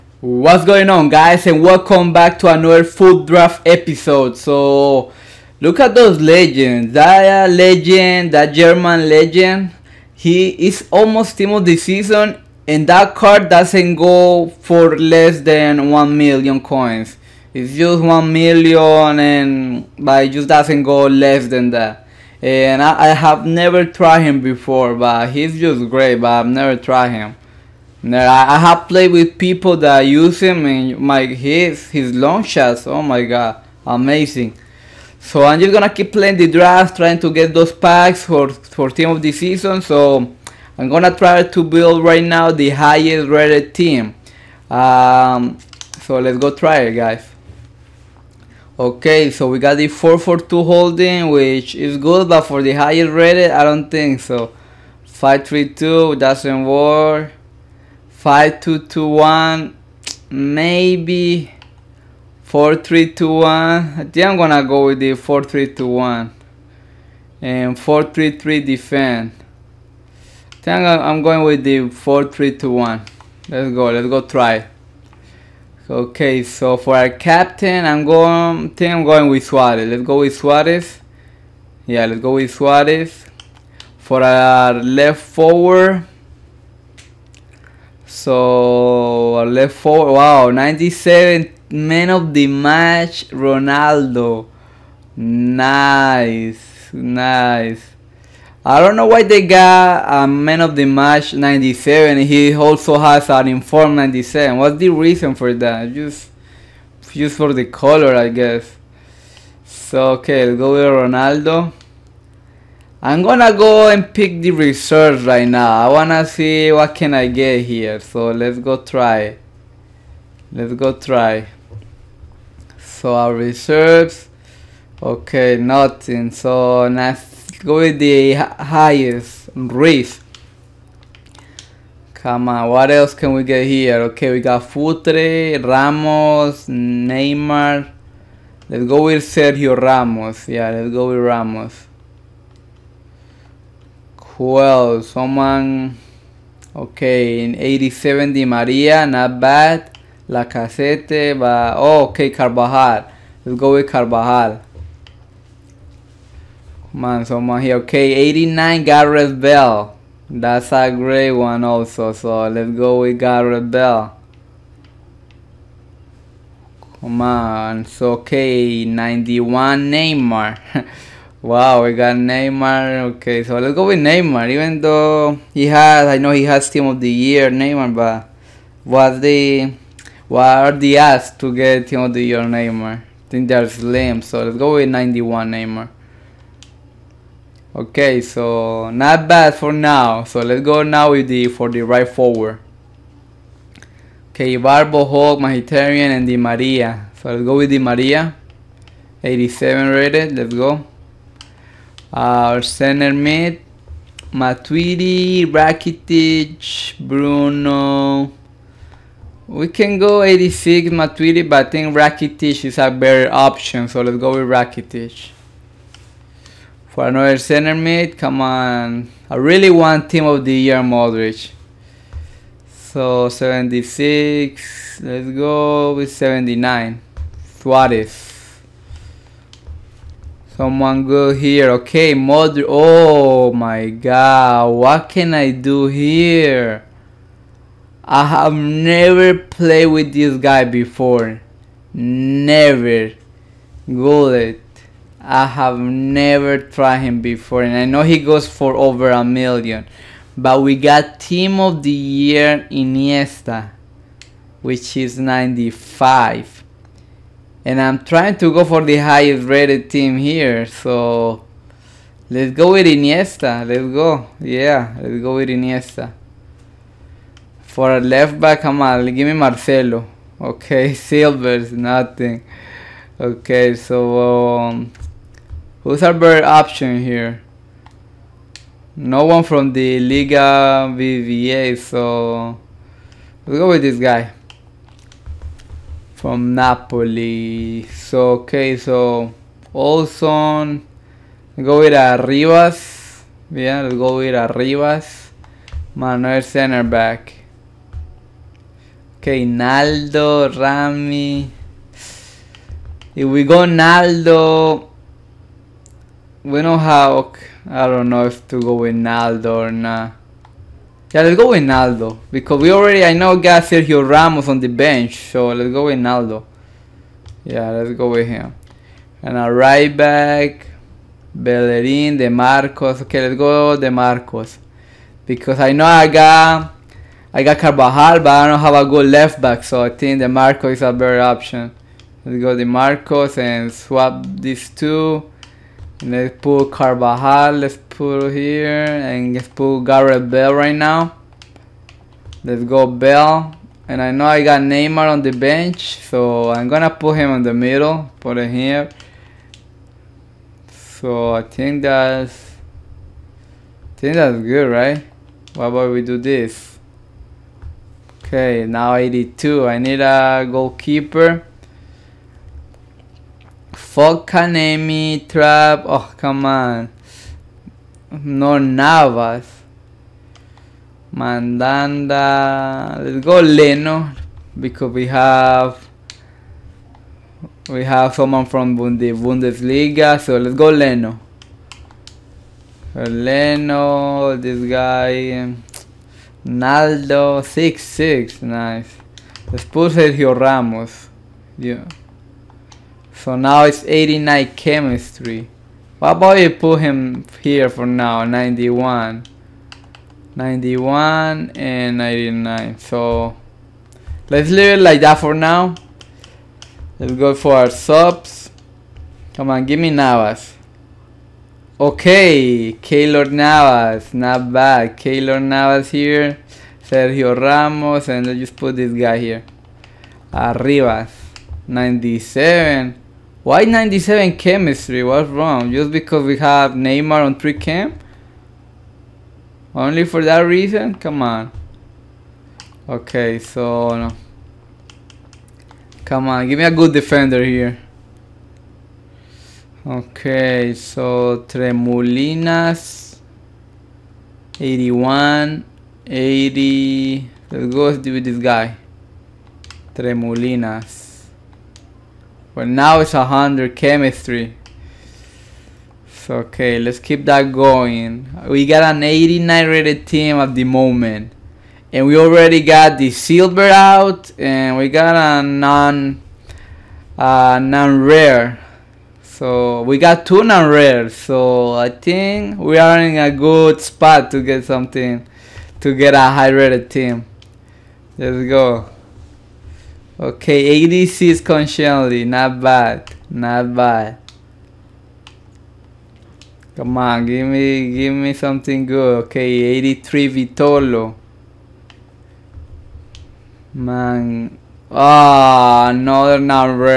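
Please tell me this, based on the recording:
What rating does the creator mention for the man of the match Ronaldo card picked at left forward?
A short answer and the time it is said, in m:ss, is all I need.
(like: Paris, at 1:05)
97, at 1:30.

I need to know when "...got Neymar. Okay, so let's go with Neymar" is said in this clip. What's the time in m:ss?
2:51.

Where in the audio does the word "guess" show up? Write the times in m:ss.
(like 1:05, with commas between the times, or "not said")
1:48.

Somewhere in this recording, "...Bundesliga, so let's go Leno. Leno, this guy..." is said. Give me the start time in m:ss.
6:19.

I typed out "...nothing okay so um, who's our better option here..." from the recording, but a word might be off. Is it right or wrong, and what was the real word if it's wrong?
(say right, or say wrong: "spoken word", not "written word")
right.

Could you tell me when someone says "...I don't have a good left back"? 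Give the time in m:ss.
5:28.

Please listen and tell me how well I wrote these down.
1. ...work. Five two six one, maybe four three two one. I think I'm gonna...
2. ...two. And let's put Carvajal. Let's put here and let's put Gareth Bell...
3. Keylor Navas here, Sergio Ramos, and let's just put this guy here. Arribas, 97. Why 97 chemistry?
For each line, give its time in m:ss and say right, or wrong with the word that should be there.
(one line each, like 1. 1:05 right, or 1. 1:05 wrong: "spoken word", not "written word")
1. 0:56 wrong: "two", not "six"
2. 5:34 right
3. 6:54 right.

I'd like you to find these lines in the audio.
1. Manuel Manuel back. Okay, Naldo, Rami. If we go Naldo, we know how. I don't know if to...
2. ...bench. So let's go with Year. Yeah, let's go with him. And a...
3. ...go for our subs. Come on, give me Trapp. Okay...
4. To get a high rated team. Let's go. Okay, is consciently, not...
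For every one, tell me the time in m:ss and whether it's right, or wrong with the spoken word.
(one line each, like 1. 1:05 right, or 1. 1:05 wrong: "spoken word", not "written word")
1. 4:55 right
2. 5:14 wrong: "Naldo", not "Year"
3. 6:47 wrong: "Navas", not "Trapp"
4. 7:55 right.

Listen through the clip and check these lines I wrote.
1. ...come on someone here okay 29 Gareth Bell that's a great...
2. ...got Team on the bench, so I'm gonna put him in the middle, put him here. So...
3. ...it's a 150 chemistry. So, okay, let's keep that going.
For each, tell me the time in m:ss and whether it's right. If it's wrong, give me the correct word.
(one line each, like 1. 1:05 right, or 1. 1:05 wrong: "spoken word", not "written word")
1. 2:36 wrong: "89", not "29"
2. 5:44 wrong: "Neymar", not "Team"
3. 7:32 wrong: "100", not "150".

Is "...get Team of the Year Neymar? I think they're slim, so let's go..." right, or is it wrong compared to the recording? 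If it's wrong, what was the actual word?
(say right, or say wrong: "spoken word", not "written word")
right.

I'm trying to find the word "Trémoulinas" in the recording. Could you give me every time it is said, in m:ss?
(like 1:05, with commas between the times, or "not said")
7:21, 7:29.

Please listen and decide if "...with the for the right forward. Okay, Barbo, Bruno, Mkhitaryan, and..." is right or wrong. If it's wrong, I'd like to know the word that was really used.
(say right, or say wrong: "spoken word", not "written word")
wrong: "Hulk", not "Bruno".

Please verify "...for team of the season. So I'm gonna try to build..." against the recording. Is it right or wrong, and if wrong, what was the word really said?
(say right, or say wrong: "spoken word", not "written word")
right.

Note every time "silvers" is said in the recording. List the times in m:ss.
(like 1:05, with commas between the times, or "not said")
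4:30, 7:43.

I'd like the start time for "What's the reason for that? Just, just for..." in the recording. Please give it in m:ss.
1:44.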